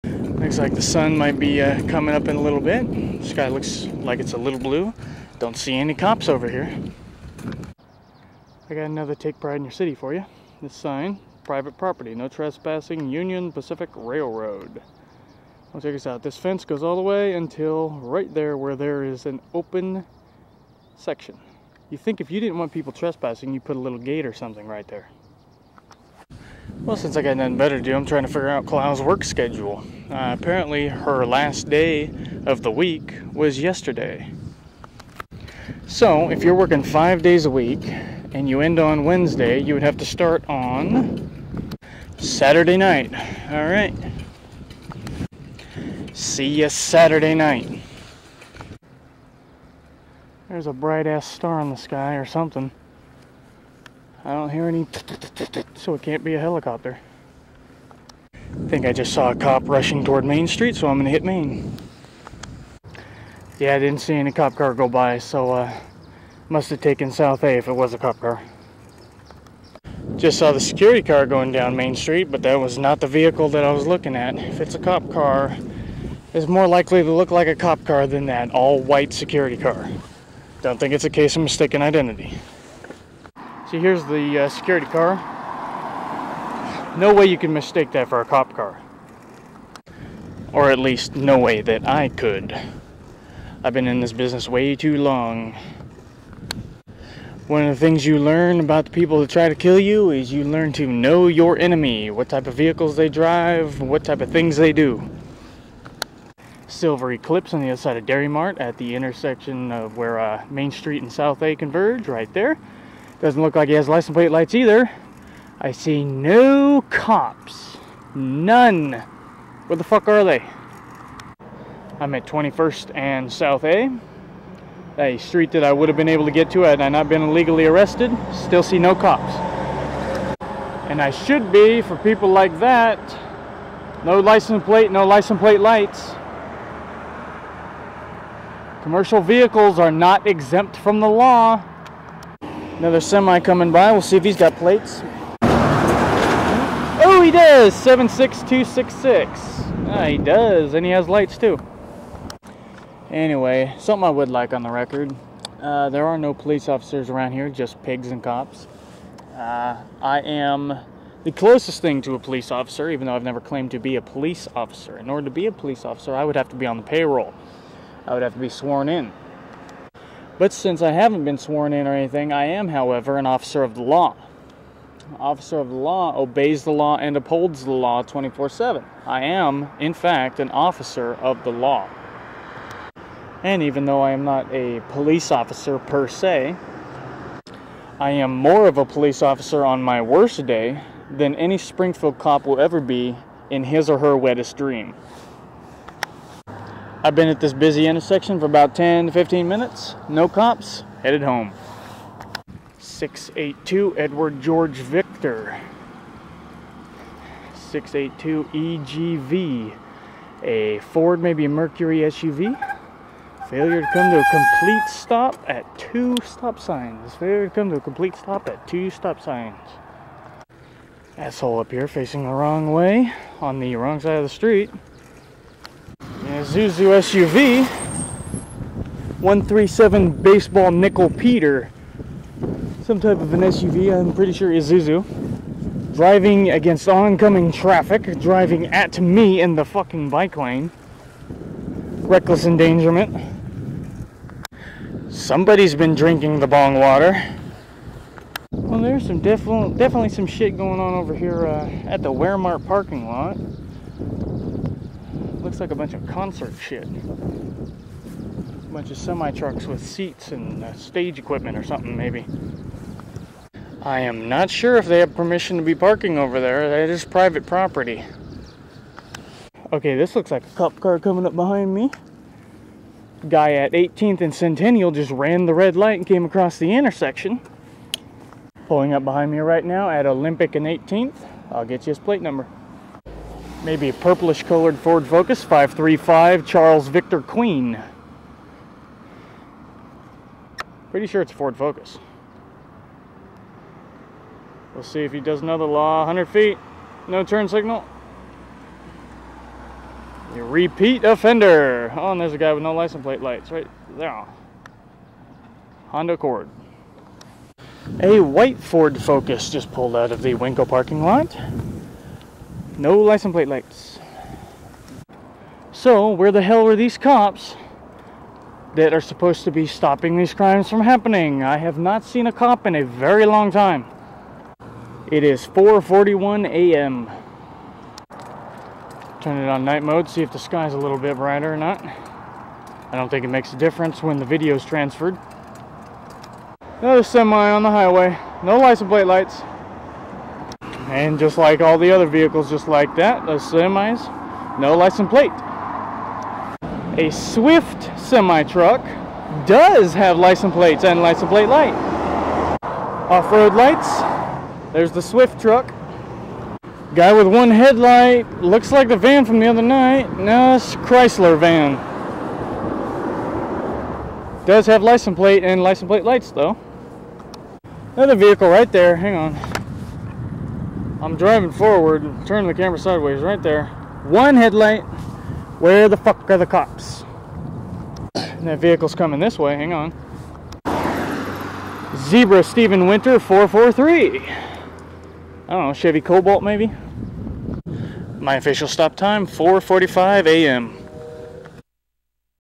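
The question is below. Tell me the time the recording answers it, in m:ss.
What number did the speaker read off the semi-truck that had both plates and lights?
2:27.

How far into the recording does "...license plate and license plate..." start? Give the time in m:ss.
6:04.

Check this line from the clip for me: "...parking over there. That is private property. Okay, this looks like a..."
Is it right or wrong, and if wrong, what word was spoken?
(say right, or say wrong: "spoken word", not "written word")
right.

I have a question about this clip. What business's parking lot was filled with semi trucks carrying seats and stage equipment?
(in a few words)
Wehrmart.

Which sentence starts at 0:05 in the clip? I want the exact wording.
Don't see any cops over here.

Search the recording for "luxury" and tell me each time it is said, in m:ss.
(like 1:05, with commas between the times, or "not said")
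not said.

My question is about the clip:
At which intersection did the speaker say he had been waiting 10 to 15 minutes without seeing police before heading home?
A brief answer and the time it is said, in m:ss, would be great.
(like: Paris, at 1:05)
21st and South A, at 2:02.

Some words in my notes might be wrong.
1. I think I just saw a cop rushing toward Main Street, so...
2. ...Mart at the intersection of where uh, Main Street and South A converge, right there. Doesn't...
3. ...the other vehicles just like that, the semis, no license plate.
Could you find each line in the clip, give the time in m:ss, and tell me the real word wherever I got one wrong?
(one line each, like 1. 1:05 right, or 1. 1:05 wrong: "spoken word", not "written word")
1. 0:58 right
2. 1:48 right
3. 5:41 right.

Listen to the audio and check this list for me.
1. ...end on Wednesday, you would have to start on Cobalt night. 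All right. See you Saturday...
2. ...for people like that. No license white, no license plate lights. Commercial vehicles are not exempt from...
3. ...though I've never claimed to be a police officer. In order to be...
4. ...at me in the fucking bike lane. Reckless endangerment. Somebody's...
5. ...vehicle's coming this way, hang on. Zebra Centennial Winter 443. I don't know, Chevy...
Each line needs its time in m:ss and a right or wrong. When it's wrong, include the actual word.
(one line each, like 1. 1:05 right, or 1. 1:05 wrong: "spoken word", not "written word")
1. 0:38 wrong: "Saturday", not "Cobalt"
2. 2:11 wrong: "plate", not "white"
3. 2:43 right
4. 3:58 right
5. 6:18 wrong: "Stephen", not "Centennial".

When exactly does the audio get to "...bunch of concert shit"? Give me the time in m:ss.
4:15.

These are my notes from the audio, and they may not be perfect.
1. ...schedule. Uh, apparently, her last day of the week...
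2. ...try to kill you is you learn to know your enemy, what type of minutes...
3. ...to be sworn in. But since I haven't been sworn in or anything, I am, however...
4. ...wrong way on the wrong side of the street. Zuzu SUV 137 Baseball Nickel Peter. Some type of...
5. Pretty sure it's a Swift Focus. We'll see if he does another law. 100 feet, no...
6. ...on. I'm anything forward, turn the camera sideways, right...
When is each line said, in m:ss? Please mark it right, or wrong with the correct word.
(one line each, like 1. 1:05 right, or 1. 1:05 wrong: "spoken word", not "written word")
1. 0:29 right
2. 1:39 wrong: "vehicles", not "minutes"
3. 2:48 right
4. 3:42 right
5. 4:50 wrong: "Ford", not "Swift"
6. 6:09 wrong: "driving", not "anything".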